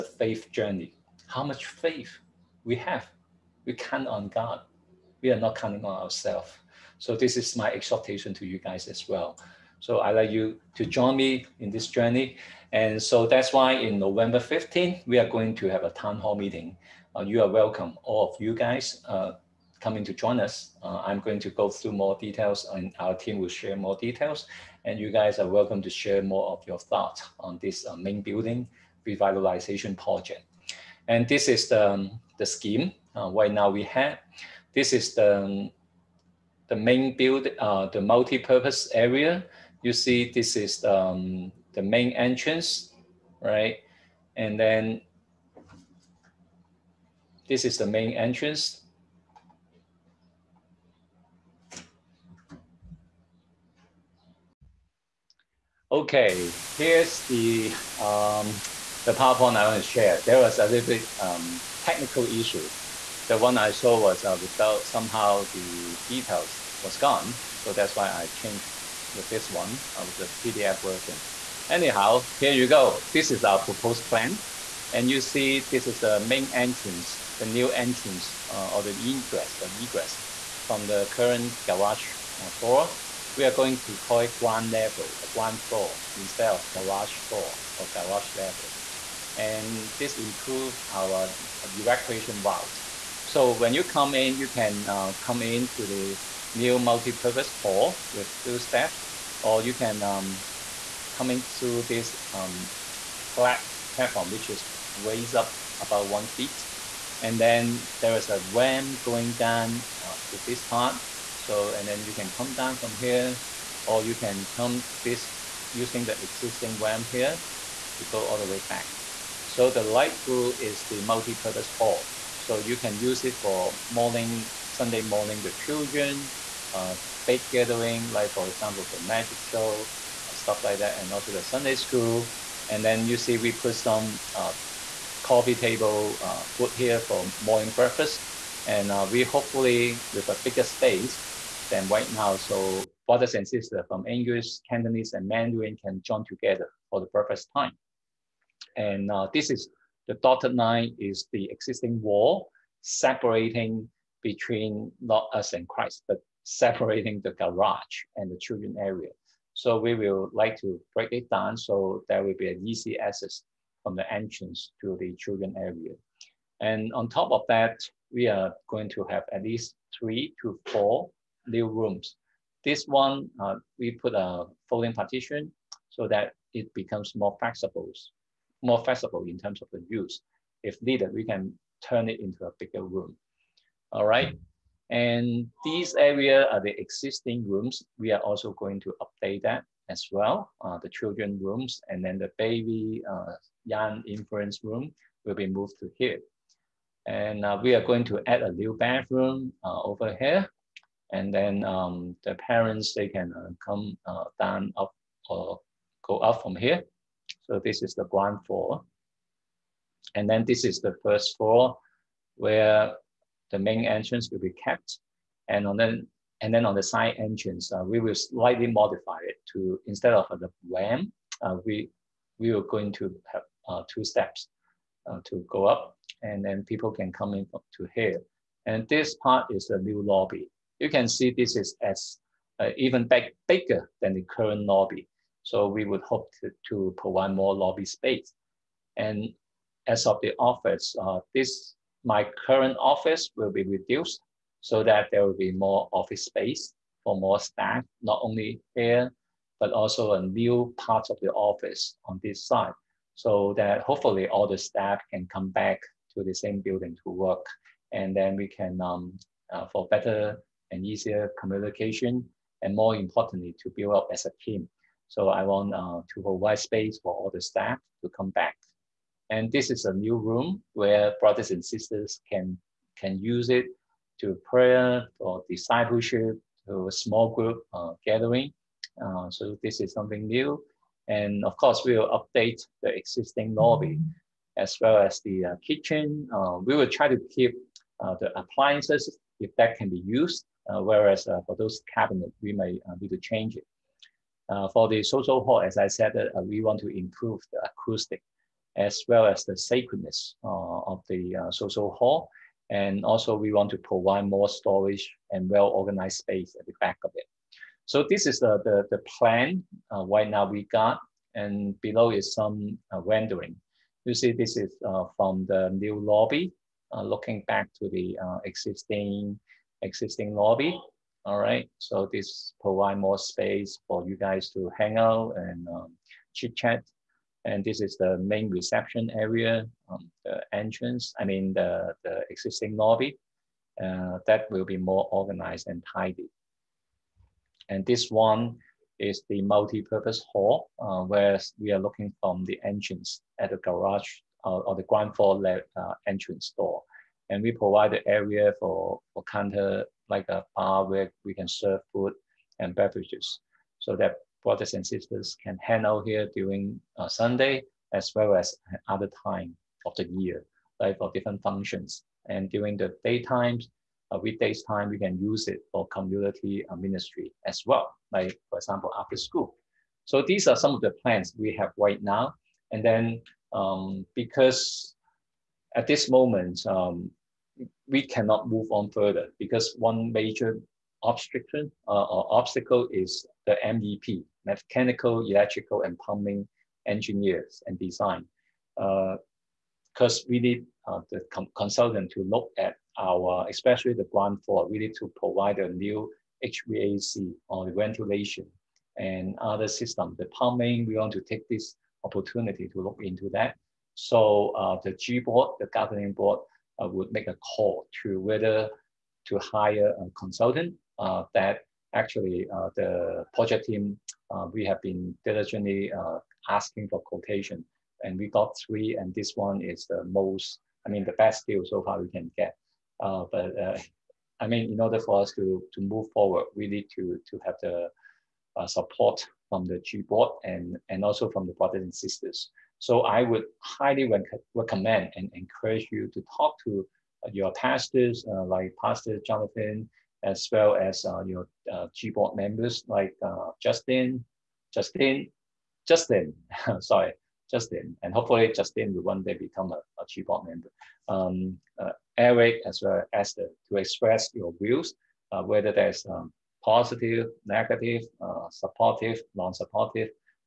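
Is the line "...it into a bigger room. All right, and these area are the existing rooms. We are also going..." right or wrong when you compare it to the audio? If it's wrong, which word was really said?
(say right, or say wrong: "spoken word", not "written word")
right.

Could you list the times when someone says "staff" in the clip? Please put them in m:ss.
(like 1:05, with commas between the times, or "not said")
4:07, 4:14, 4:27.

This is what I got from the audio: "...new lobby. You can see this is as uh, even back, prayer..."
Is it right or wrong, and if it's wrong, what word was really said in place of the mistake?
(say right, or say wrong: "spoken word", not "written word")
wrong: "bigger", not "prayer".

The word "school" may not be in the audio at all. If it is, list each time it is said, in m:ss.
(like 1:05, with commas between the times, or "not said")
2:11, 6:09.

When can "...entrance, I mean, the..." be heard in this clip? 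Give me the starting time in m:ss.
5:30.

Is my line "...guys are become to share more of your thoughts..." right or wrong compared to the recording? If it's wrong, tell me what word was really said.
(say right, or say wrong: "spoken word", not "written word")
wrong: "welcome", not "become".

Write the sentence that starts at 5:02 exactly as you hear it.
And also we want to provide more storage and well-organized space at the back of it.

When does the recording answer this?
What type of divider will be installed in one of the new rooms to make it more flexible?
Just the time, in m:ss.
2:54.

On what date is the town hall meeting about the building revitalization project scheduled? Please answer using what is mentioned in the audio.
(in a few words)
November 15.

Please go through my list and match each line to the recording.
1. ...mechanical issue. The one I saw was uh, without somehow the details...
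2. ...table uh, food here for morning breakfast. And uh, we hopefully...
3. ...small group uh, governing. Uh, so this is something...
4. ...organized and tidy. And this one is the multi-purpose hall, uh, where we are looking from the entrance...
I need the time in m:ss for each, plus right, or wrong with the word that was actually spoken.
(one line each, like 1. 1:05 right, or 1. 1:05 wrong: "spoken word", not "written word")
1. 1:01 wrong: "technical", not "mechanical"
2. 2:15 right
3. 4:36 wrong: "gathering", not "governing"
4. 5:35 right.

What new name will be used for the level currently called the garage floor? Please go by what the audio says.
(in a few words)
ground level.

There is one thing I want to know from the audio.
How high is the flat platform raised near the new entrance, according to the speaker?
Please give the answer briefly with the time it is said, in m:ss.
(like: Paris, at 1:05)
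1 foot, at 1:46.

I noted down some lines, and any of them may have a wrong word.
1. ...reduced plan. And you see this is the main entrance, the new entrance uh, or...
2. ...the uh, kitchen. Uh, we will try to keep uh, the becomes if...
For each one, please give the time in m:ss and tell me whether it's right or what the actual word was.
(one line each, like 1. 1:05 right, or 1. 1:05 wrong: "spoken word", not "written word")
1. 1:13 wrong: "proposed", not "reduced"
2. 4:45 wrong: "appliances", not "becomes".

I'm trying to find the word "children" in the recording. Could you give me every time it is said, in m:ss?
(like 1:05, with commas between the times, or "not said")
2:05, 2:38, 2:45, 3:10.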